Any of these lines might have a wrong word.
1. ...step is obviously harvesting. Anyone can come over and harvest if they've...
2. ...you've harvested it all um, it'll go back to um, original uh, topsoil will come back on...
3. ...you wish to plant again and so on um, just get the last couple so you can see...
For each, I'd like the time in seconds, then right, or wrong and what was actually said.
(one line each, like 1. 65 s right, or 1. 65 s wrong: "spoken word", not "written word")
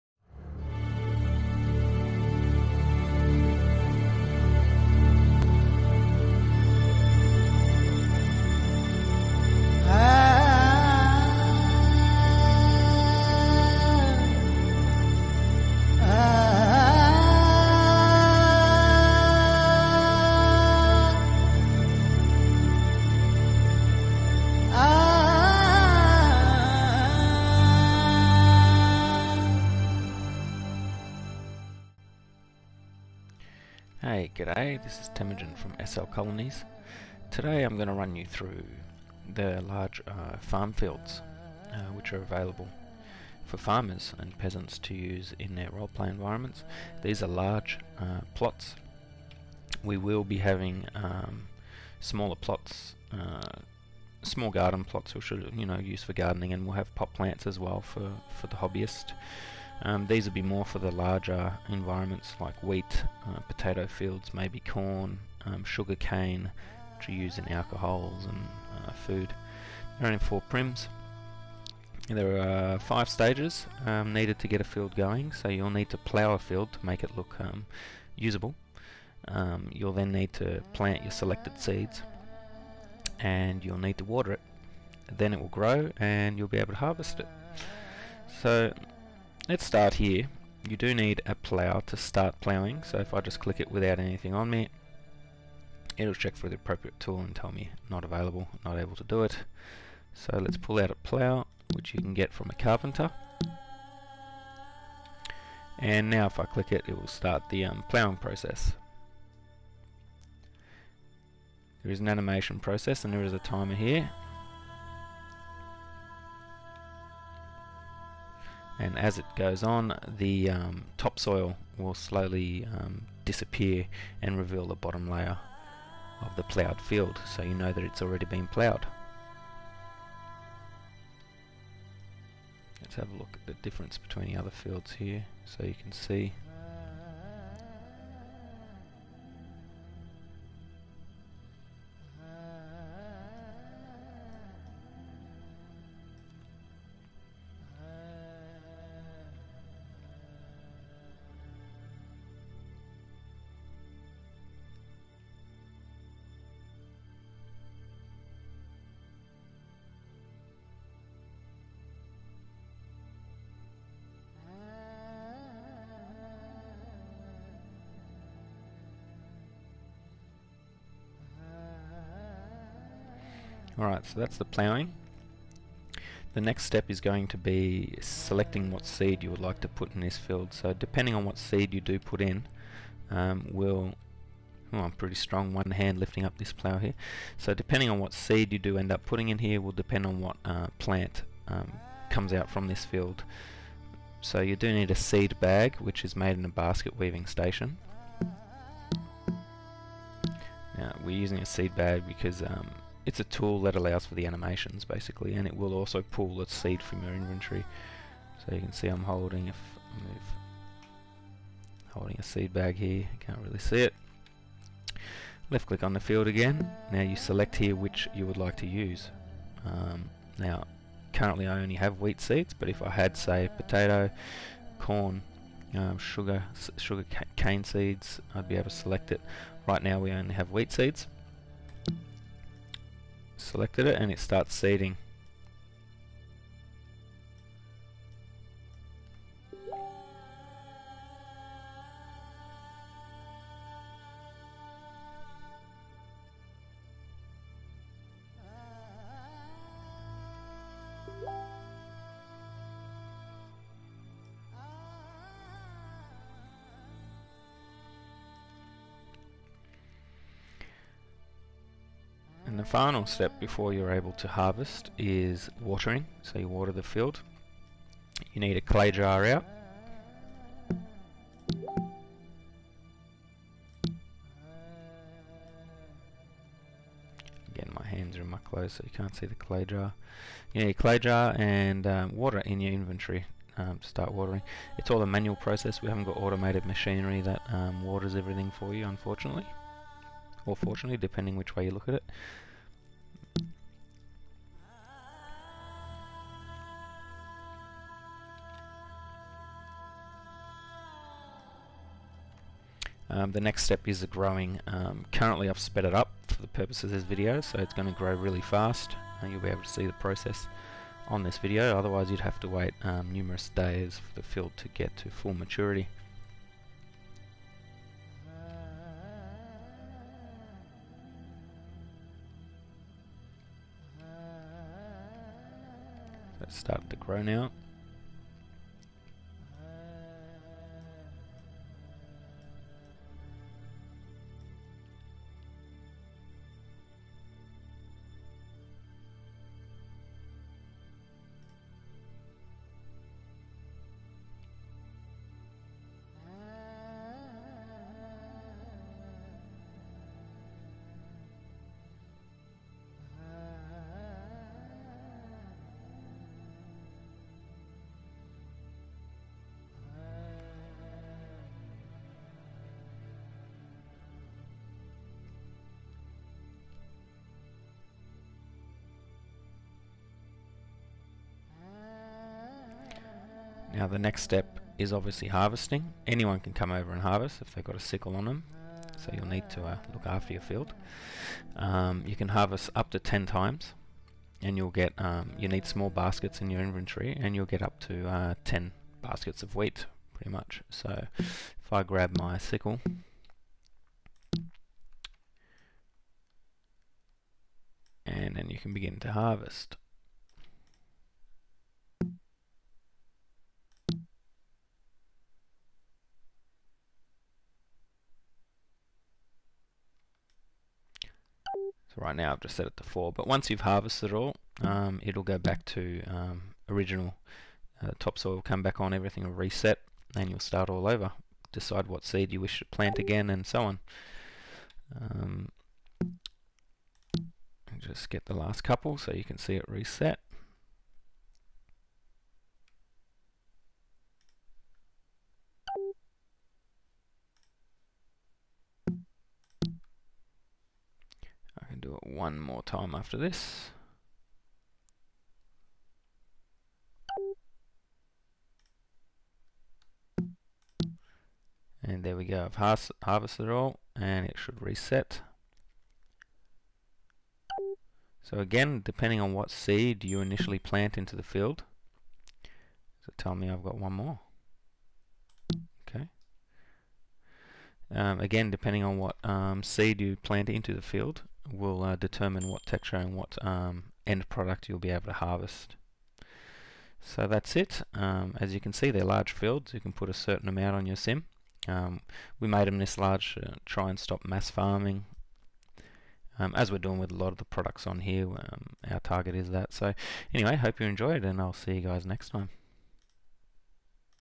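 1. 374 s right
2. 413 s right
3. 422 s right.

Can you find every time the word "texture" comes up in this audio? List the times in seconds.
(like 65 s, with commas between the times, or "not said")
472 s.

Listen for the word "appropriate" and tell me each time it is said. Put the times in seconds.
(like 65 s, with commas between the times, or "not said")
96 s.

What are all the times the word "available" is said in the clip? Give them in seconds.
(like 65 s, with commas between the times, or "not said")
42 s, 98 s.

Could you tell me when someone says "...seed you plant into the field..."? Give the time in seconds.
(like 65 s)
469 s.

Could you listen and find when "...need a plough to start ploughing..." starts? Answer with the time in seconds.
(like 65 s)
90 s.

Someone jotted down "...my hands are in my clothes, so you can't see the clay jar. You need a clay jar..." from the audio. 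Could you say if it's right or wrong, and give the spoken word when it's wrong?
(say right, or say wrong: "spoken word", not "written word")
right.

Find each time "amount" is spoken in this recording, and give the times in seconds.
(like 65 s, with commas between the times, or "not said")
480 s.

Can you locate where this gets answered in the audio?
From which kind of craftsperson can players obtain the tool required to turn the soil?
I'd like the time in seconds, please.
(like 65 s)
102 s.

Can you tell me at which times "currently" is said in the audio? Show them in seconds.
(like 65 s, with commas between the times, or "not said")
221 s, 305 s.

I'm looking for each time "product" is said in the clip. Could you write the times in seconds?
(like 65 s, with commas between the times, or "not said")
474 s, 487 s.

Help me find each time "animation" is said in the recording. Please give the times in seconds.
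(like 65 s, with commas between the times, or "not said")
112 s, 204 s.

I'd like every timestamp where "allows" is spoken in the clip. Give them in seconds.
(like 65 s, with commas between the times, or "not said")
203 s.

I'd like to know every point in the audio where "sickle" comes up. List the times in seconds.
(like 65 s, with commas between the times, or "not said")
377 s, 392 s.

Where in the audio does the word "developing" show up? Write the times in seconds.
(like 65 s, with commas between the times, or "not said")
not said.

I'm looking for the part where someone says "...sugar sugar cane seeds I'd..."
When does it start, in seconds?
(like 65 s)
225 s.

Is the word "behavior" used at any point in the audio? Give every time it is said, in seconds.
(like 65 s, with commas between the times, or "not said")
not said.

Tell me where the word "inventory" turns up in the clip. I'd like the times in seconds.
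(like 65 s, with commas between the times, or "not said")
207 s, 282 s, 386 s.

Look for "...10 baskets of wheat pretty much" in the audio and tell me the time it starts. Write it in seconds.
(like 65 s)
388 s.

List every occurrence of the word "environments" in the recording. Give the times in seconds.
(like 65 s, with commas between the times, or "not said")
46 s, 61 s.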